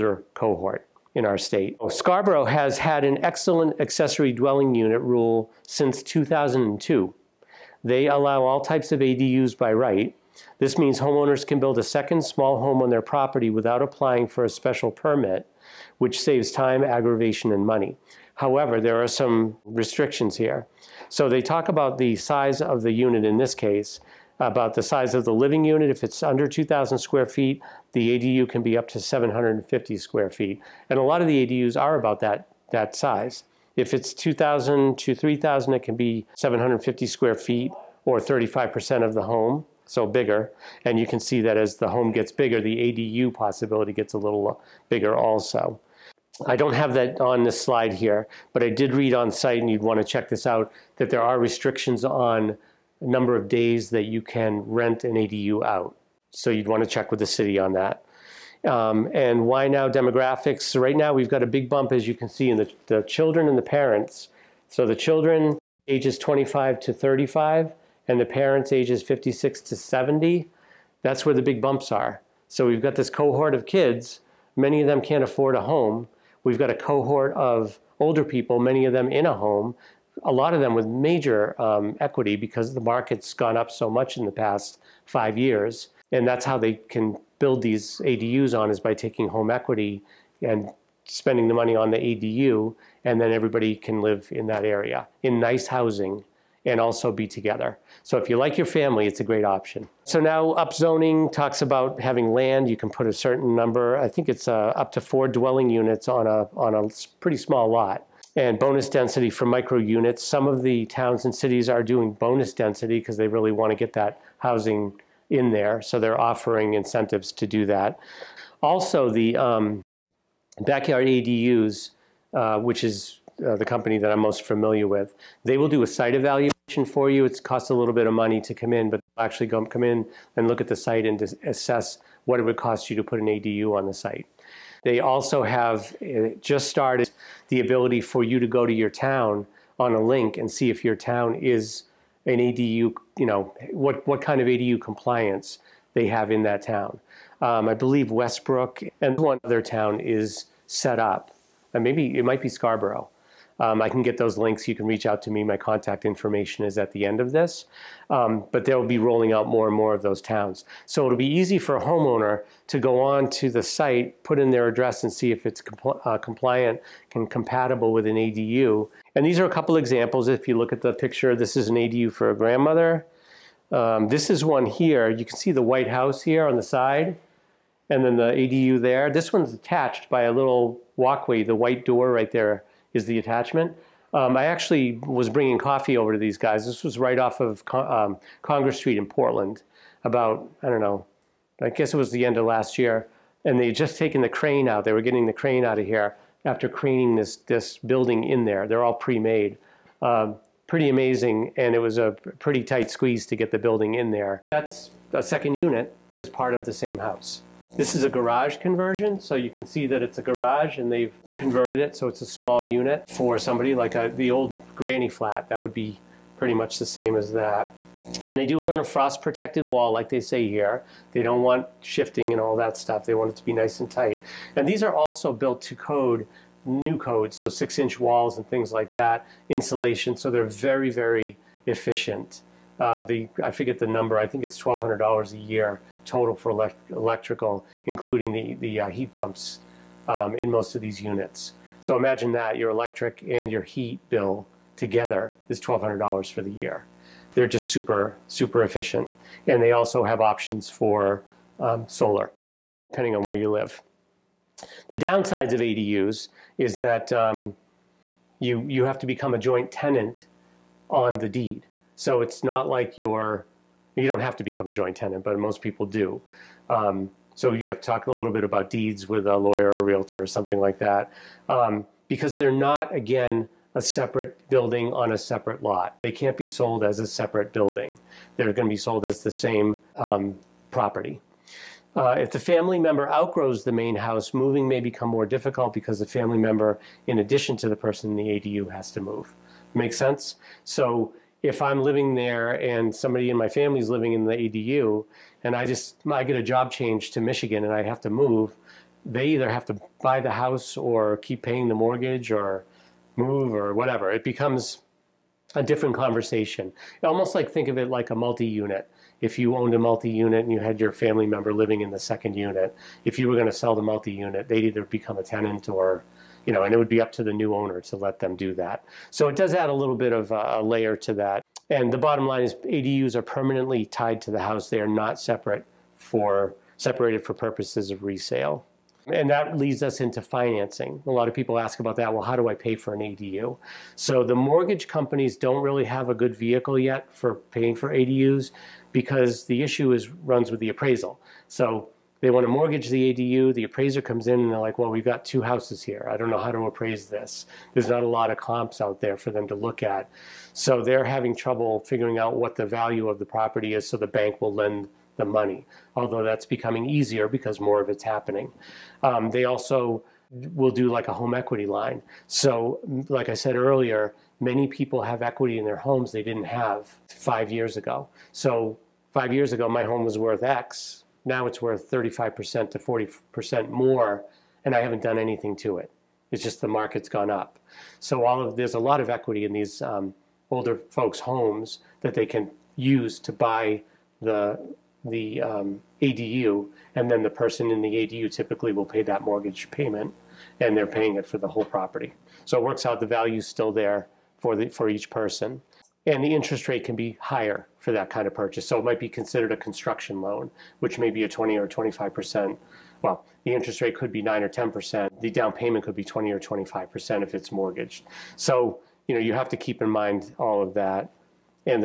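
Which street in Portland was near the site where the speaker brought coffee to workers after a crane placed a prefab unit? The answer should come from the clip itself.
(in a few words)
Congress Street.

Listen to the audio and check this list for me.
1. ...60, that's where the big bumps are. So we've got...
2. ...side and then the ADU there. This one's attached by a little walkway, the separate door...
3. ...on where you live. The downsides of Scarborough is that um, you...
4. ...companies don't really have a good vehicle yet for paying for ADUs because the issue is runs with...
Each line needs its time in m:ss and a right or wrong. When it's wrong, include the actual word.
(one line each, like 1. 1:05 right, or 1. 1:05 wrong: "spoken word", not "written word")
1. 1:09 wrong: "70", not "60"
2. 2:56 wrong: "white", not "separate"
3. 4:13 wrong: "ADUs", not "Scarborough"
4. 5:34 right.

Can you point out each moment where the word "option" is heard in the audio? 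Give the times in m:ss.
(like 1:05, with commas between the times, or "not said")
1:39, 4:10.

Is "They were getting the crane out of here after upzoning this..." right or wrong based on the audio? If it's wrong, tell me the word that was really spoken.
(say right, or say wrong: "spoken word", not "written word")
wrong: "craning", not "upzoning".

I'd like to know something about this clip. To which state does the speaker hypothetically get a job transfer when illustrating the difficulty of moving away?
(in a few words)
Michigan.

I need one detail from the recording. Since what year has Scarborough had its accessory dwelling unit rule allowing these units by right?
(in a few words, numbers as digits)
2002.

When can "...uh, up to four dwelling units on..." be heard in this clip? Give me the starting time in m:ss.
1:44.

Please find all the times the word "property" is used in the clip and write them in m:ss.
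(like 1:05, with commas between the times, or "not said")
0:13, 4:40, 5:53, 6:31.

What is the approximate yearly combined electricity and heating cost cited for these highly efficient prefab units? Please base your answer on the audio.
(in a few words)
$1,200.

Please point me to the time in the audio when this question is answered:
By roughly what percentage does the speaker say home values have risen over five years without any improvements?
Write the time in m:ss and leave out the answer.
6:11.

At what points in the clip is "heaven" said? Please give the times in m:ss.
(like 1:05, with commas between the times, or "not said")
not said.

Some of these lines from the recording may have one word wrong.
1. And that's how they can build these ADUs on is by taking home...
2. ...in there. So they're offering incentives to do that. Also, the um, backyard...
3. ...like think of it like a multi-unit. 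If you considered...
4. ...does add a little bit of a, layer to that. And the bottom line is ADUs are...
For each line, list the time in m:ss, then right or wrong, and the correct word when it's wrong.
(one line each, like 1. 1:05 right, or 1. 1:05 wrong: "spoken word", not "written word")
1. 1:26 right
2. 1:55 right
3. 5:07 wrong: "owned", not "considered"
4. 5:19 right.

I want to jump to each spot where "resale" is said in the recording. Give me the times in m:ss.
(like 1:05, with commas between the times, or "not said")
5:28.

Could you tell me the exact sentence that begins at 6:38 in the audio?
So it might be considered a construction loan, which may be a 20 or 25 percent.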